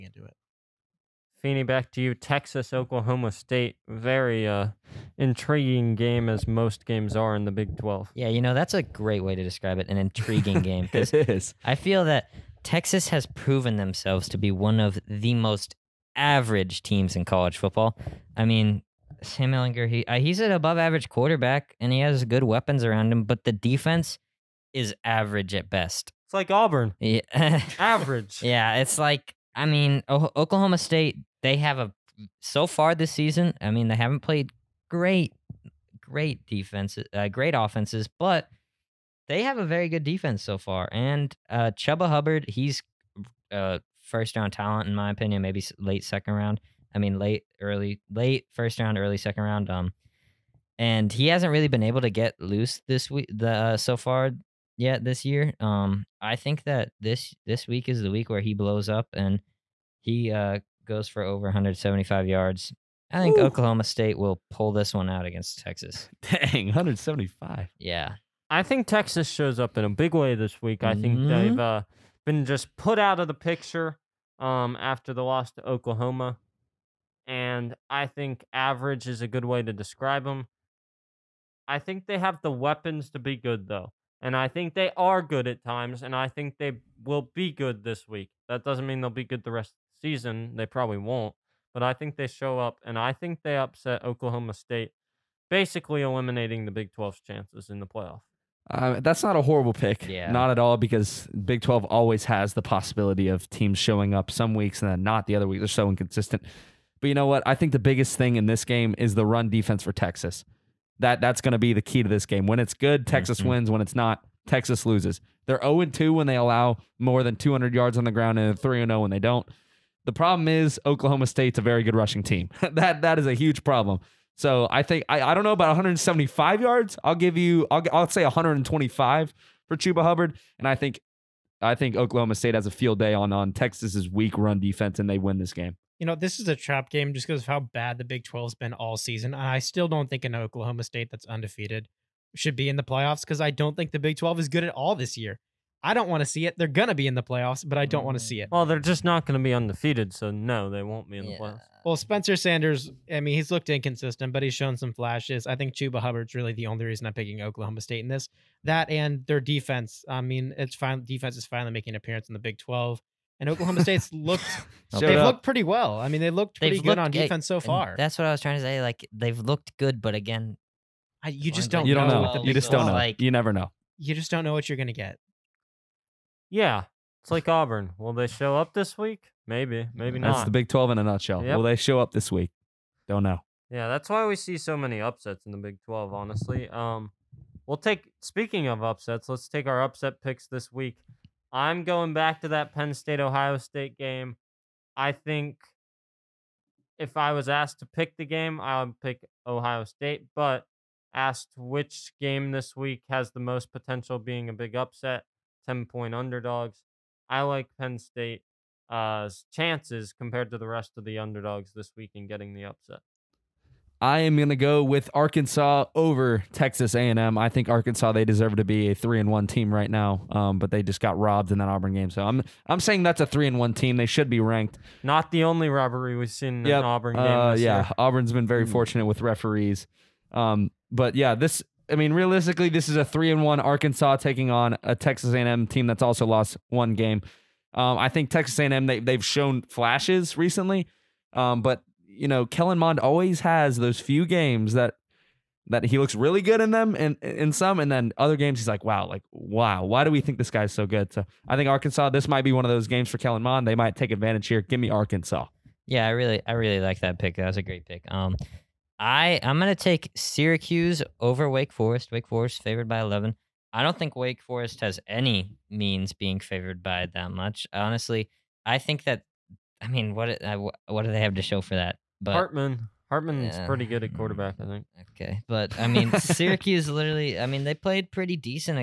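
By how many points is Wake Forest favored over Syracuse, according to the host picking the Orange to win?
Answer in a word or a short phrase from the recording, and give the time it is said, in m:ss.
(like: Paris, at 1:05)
11, at 4:23.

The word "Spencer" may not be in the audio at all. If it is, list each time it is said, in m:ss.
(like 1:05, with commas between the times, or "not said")
2:31.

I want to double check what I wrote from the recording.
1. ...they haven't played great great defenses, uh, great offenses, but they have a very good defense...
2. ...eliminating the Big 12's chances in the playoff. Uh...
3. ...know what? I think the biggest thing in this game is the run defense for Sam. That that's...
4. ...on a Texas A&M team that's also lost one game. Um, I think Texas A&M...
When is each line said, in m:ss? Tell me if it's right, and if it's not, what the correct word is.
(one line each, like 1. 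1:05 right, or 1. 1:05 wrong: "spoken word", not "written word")
1. 0:33 right
2. 1:36 right
3. 1:47 wrong: "Texas", not "Sam"
4. 3:54 right.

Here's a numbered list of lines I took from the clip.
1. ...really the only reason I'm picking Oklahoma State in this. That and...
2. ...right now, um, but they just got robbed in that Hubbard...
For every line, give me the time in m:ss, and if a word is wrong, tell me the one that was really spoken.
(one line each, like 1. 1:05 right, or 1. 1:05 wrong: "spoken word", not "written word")
1. 2:36 right
2. 3:39 wrong: "Auburn", not "Hubbard".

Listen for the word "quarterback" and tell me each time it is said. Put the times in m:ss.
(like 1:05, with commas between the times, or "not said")
0:21, 4:34.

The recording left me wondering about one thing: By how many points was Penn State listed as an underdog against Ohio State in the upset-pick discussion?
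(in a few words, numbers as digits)
10.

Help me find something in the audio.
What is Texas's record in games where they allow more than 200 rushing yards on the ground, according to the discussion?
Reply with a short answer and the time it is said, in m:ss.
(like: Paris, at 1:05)
0-2, at 1:55.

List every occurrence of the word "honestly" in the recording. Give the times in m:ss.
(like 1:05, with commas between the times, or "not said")
3:06, 4:27.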